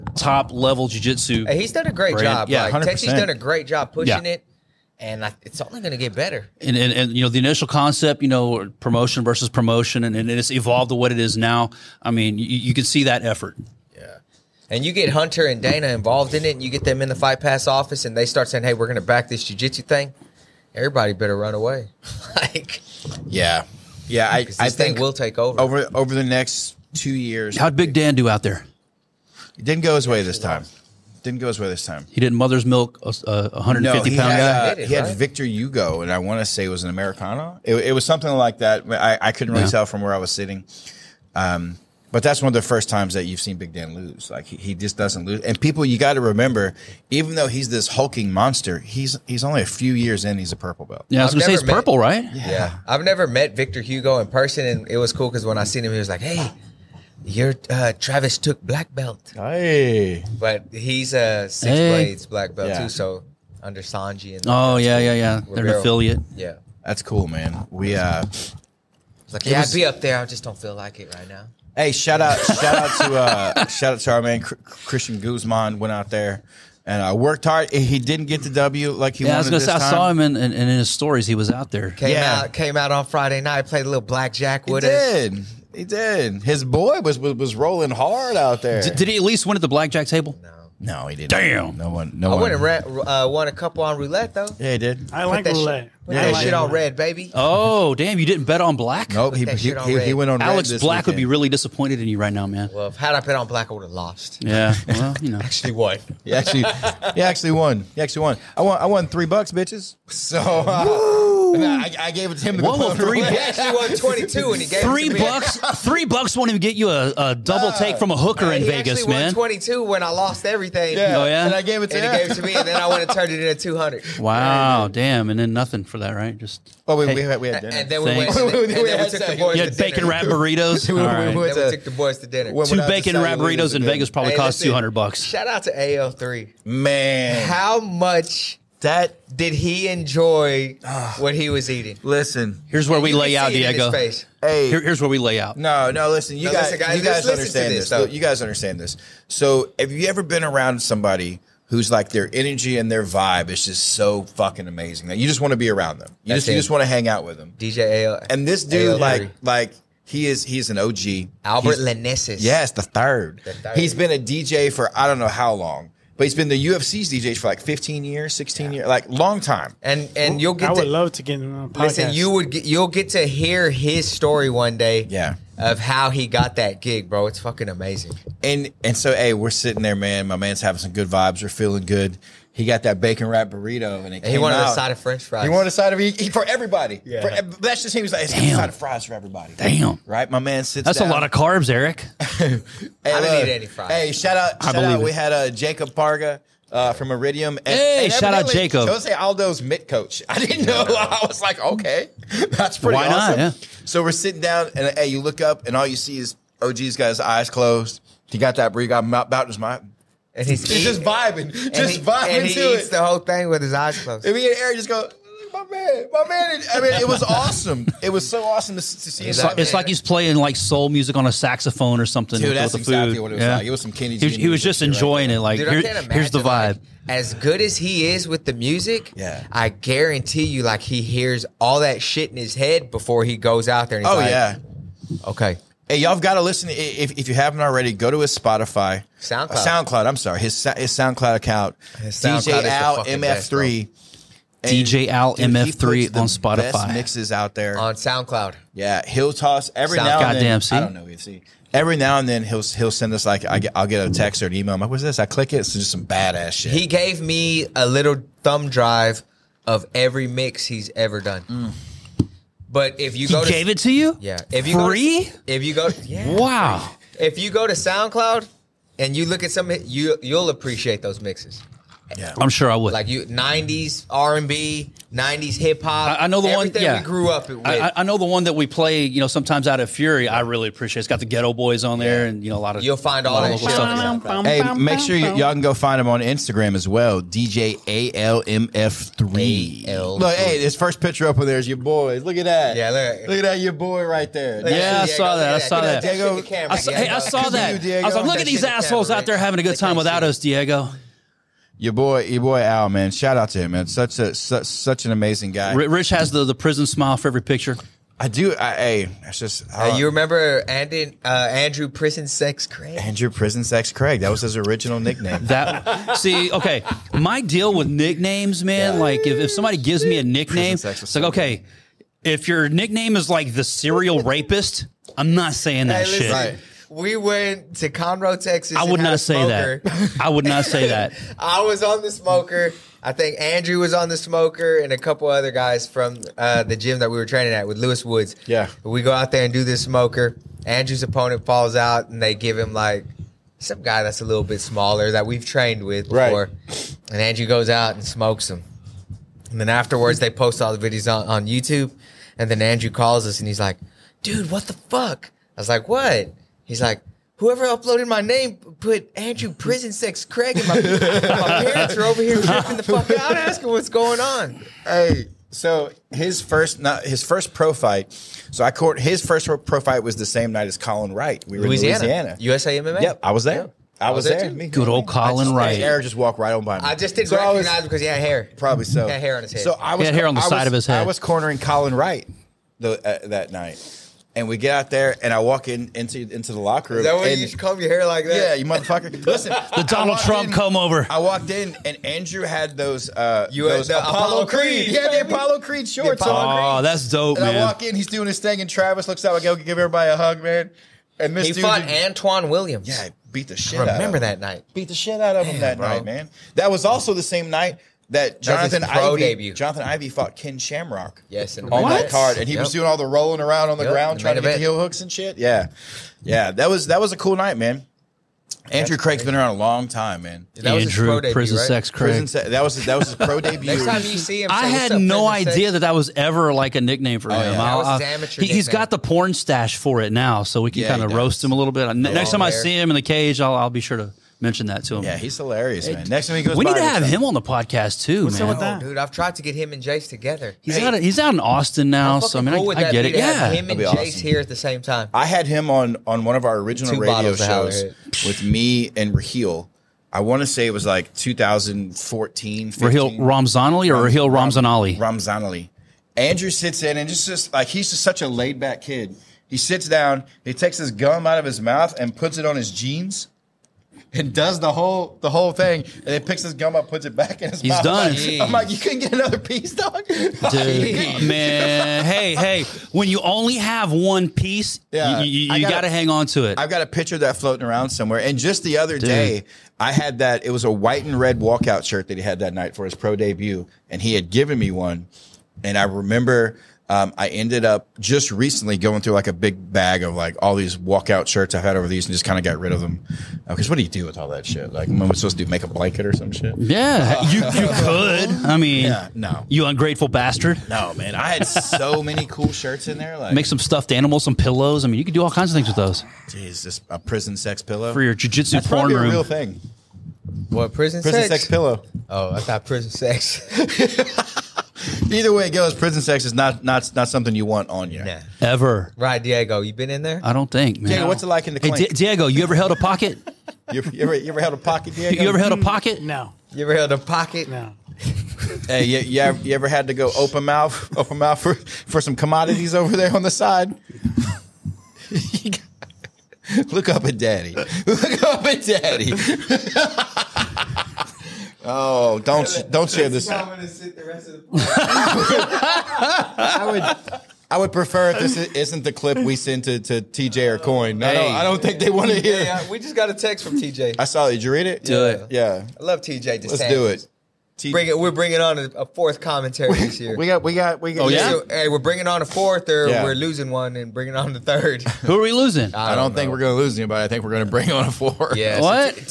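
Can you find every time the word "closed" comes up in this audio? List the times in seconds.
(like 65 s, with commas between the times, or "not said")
207 s, 214 s.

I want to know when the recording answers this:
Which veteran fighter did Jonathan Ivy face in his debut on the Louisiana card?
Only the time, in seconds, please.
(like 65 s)
410 s.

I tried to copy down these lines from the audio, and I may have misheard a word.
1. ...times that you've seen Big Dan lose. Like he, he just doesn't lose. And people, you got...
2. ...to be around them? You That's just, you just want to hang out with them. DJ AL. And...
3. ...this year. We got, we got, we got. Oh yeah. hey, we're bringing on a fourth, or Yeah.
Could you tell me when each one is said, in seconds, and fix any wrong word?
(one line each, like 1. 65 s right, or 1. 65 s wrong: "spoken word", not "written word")
1. 42 s right
2. 155 s right
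3. 559 s right.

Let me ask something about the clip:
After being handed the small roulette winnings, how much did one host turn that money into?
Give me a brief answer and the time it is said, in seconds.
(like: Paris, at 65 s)
200, at 123 s.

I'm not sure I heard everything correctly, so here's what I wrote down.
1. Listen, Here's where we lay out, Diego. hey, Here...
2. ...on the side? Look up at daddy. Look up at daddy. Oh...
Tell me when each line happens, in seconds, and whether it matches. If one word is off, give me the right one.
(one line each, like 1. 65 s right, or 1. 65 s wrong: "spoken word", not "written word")
1. 142 s right
2. 533 s right.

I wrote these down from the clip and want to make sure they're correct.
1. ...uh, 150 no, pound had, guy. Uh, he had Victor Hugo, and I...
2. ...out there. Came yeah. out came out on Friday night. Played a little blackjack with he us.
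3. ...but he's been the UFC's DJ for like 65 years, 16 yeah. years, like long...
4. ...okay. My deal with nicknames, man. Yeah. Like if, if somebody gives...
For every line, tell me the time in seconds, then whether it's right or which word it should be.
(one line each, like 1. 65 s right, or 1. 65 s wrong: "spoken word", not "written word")
1. 33 s right
2. 81 s right
3. 166 s wrong: "15", not "65"
4. 316 s right.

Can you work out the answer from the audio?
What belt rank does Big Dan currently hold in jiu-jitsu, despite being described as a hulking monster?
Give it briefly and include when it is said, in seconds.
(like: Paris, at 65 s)
Purple belt, at 50 s.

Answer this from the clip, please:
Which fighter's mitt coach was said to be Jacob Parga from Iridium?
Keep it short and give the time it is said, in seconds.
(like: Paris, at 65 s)
Jose Aldo, at 198 s.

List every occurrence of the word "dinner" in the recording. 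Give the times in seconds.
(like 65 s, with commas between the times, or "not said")
127 s, 132 s.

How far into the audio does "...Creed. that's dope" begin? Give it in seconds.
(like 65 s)
396 s.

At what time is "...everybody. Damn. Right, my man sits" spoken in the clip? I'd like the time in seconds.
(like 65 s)
189 s.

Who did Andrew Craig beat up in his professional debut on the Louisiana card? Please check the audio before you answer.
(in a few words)
Antoine Williams.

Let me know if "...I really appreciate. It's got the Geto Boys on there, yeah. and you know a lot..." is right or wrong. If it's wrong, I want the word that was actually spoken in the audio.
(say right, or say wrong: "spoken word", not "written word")
right.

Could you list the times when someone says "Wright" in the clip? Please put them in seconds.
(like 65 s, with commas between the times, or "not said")
371 s, 375 s, 381 s.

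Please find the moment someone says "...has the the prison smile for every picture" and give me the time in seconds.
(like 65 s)
306 s.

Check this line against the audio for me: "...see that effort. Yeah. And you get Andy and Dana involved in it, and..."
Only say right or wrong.
wrong.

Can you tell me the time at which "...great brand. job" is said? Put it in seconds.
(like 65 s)
1 s.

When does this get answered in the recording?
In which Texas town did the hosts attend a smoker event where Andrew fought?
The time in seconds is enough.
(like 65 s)
327 s.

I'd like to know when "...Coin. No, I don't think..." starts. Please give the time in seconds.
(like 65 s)
550 s.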